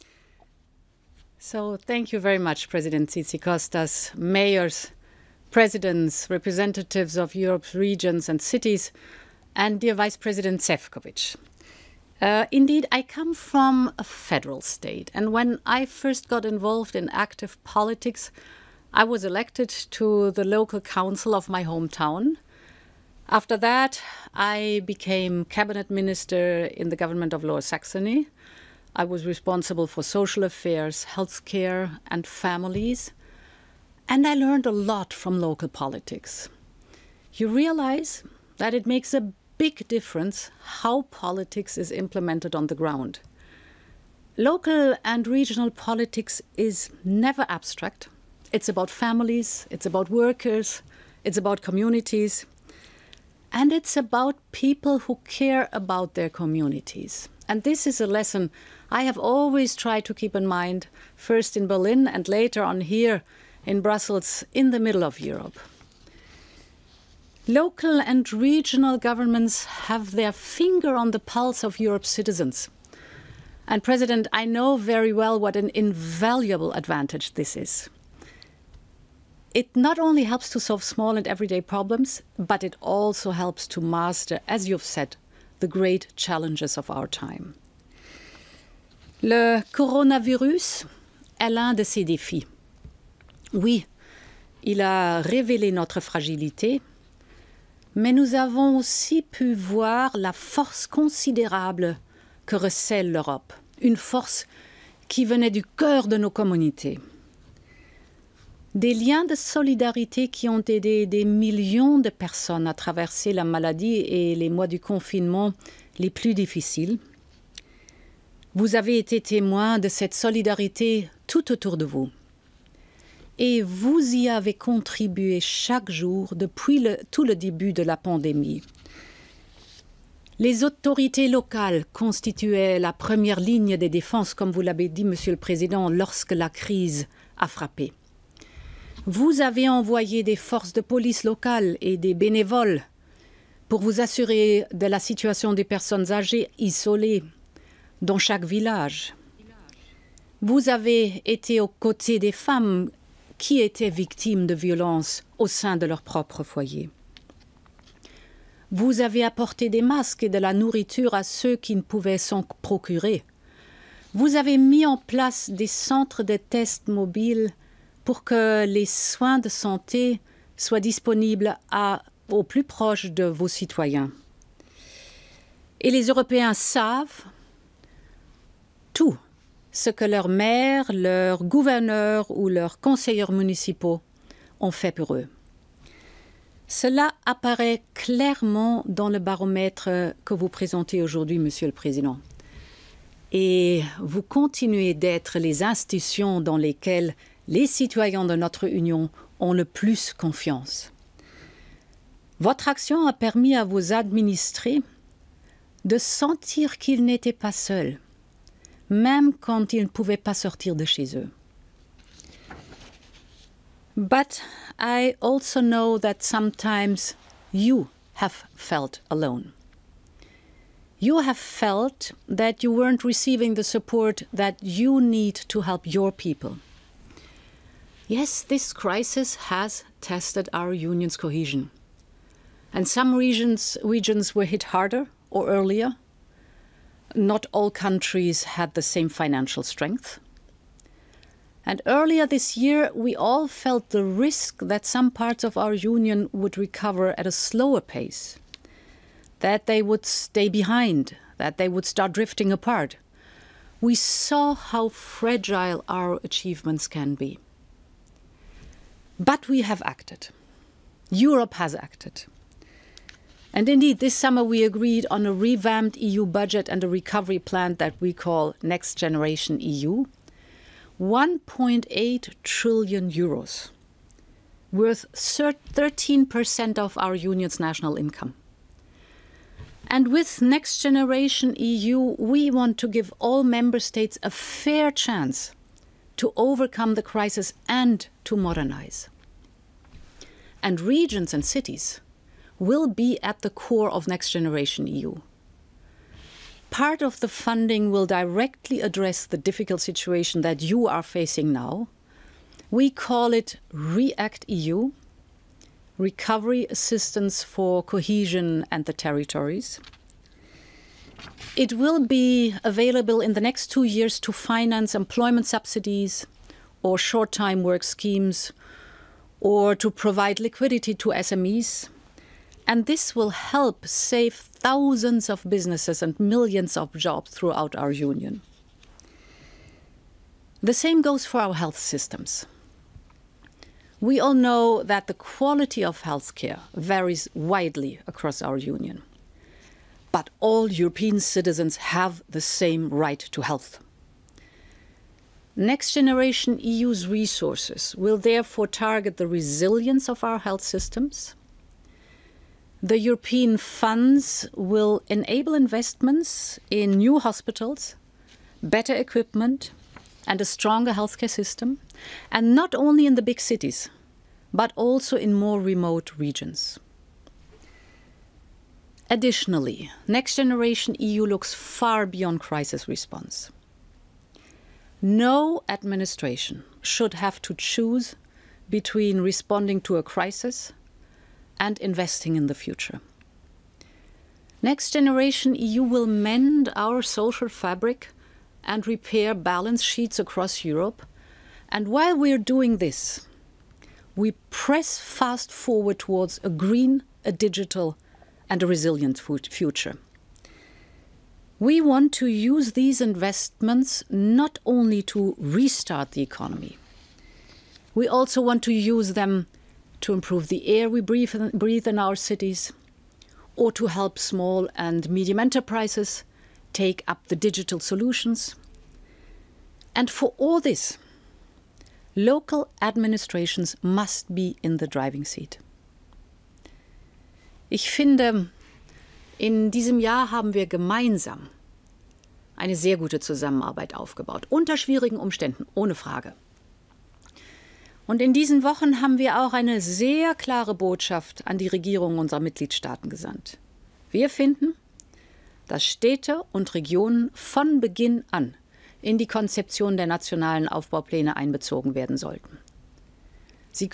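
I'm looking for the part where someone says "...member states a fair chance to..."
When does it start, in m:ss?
4:43.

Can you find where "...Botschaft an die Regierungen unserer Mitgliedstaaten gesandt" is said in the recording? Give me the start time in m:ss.
7:20.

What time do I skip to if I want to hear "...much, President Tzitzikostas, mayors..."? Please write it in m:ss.
0:02.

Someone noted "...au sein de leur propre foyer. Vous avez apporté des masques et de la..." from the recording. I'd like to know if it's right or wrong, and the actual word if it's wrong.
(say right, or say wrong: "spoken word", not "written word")
right.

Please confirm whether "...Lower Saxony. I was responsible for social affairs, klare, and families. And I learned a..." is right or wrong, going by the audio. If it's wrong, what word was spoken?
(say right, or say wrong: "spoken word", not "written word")
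wrong: "healthcare", not "klare".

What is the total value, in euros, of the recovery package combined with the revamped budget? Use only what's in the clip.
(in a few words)
1.8 trillion euros.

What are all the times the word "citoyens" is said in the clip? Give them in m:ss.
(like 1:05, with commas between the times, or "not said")
2:53, 3:17.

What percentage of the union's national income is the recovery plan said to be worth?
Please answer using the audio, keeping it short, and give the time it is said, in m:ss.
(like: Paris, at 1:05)
13%, at 4:35.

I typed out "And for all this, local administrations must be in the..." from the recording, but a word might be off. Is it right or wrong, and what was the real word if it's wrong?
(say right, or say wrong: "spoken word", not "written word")
right.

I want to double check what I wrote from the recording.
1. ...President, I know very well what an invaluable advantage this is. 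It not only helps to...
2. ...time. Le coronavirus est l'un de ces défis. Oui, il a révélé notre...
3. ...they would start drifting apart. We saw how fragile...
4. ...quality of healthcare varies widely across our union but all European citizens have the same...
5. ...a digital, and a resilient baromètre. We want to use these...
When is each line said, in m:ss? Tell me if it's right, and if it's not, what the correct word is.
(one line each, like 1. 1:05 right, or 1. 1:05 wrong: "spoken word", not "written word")
1. 1:13 right
2. 1:27 right
3. 4:11 right
4. 5:35 right
5. 6:37 wrong: "future", not "baromètre".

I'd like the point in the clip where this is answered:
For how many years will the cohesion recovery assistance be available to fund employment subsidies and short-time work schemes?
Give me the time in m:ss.
5:13.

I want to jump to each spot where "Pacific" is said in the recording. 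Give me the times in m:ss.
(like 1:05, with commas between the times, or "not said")
not said.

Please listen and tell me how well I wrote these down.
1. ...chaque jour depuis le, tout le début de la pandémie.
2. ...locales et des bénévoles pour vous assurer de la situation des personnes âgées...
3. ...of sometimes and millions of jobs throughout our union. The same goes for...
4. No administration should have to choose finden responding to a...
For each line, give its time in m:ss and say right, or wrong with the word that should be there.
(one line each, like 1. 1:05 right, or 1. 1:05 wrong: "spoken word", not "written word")
1. 2:05 right
2. 2:21 right
3. 5:25 wrong: "businesses", not "sometimes"
4. 6:15 wrong: "between", not "finden".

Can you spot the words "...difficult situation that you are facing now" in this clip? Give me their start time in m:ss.
4:59.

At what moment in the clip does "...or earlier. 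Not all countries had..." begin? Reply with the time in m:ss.
3:55.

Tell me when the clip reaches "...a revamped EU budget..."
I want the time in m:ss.
4:25.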